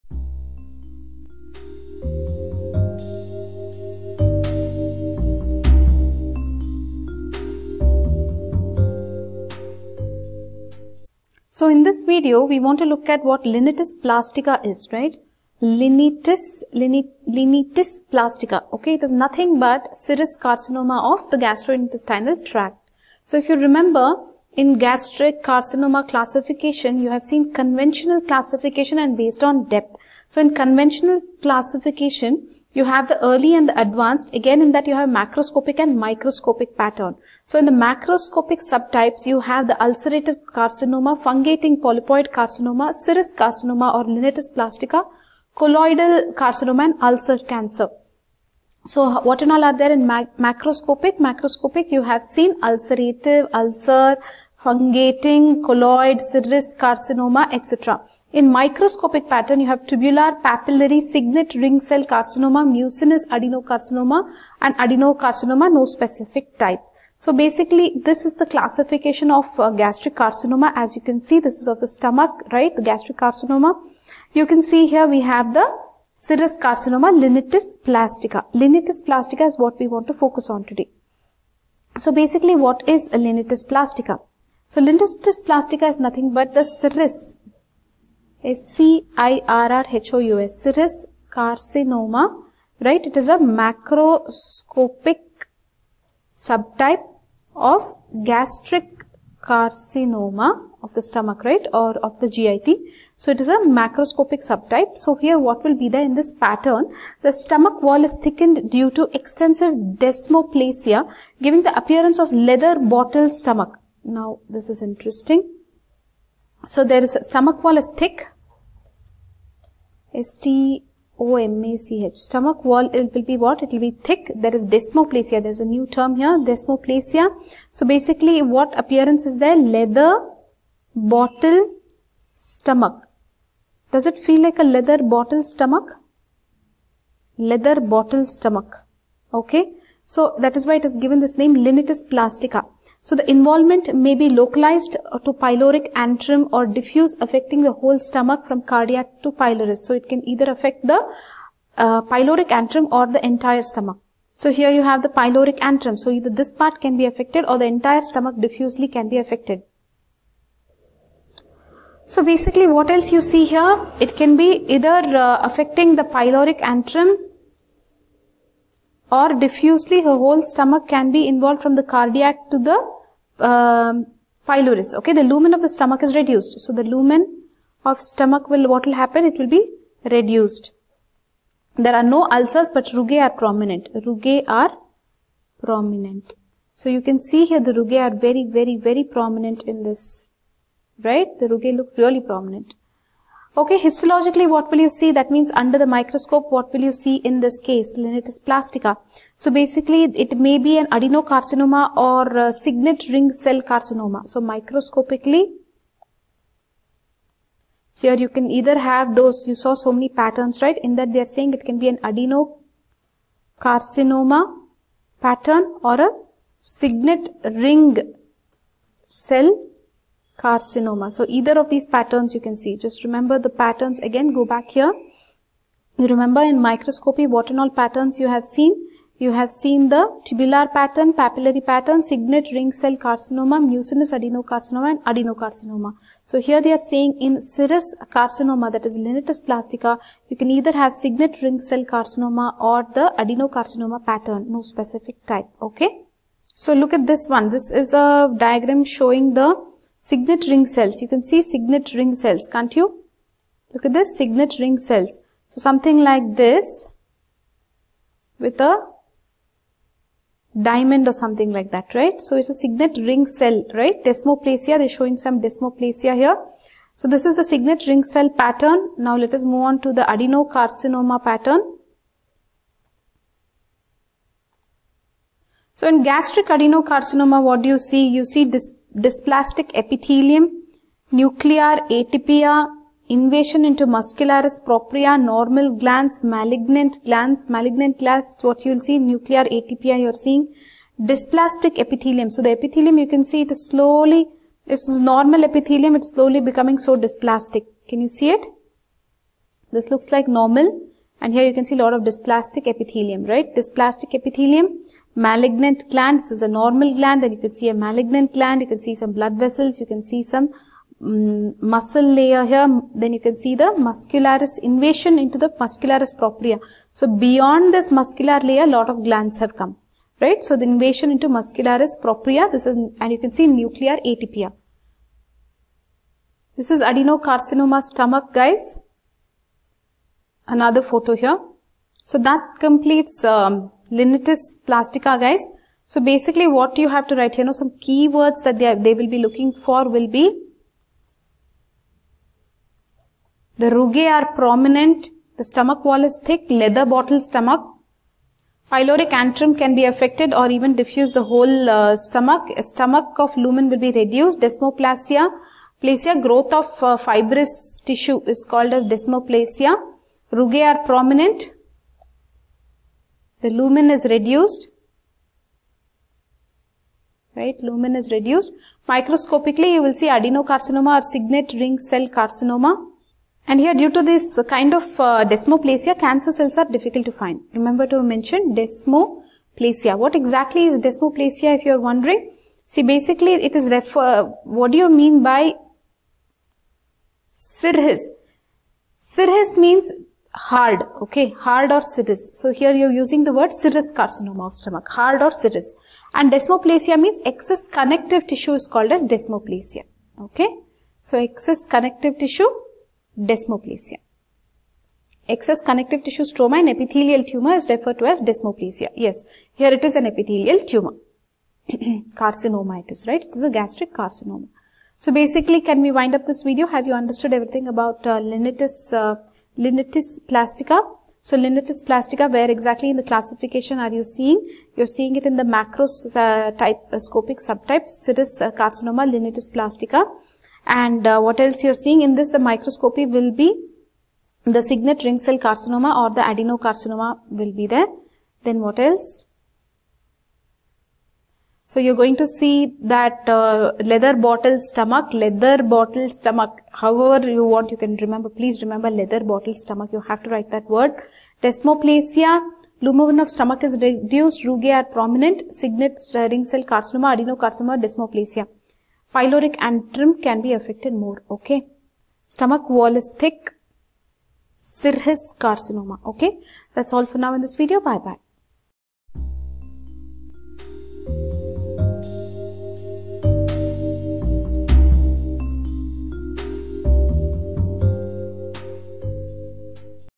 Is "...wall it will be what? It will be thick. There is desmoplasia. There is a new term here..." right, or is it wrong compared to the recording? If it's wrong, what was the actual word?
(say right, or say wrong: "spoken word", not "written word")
right.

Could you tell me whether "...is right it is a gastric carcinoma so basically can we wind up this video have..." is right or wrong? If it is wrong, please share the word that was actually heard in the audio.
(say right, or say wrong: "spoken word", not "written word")
right.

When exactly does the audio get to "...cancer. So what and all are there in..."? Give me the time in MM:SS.
00:47.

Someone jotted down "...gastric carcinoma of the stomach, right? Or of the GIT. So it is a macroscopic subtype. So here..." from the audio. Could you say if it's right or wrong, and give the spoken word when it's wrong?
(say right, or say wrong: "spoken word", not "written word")
right.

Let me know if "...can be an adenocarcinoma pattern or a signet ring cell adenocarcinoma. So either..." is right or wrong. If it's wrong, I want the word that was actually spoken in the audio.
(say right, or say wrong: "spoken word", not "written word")
wrong: "carcinoma", not "adenocarcinoma".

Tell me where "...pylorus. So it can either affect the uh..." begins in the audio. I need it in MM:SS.
02:29.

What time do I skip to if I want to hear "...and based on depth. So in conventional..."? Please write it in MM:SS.
00:28.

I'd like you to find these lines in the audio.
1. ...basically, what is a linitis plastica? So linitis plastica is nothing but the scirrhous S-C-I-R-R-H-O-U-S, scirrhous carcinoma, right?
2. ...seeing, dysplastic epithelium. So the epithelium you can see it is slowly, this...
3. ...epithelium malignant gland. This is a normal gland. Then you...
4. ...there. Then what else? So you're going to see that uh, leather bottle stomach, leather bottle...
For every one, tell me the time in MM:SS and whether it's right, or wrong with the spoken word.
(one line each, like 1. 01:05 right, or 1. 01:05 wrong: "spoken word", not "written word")
1. 01:22 right
2. 04:50 right
3. 05:04 right
4. 07:17 right.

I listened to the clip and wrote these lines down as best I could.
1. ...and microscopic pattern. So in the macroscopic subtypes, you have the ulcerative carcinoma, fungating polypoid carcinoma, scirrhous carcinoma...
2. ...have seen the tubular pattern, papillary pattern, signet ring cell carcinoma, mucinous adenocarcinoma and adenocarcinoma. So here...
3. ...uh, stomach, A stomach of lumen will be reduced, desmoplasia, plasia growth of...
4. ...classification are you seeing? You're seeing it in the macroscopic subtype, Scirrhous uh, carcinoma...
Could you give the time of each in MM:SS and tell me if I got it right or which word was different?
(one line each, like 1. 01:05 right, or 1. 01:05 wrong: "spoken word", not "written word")
1. 00:35 right
2. 03:49 right
3. 05:51 right
4. 07:03 right.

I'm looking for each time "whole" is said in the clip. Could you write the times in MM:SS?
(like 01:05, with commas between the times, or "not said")
02:27, 02:50, 05:51.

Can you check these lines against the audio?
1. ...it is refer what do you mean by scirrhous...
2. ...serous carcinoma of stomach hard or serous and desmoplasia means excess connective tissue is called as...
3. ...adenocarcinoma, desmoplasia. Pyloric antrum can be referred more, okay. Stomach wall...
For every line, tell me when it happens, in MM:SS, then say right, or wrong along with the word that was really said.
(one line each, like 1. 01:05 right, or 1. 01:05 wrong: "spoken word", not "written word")
1. 06:23 right
2. 06:33 right
3. 07:37 wrong: "affected", not "referred".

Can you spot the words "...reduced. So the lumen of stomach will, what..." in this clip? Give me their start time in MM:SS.
02:56.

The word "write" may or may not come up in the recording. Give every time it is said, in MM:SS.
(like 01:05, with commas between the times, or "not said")
05:37, 07:30.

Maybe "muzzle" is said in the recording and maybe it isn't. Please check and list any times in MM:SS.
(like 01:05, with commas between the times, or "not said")
not said.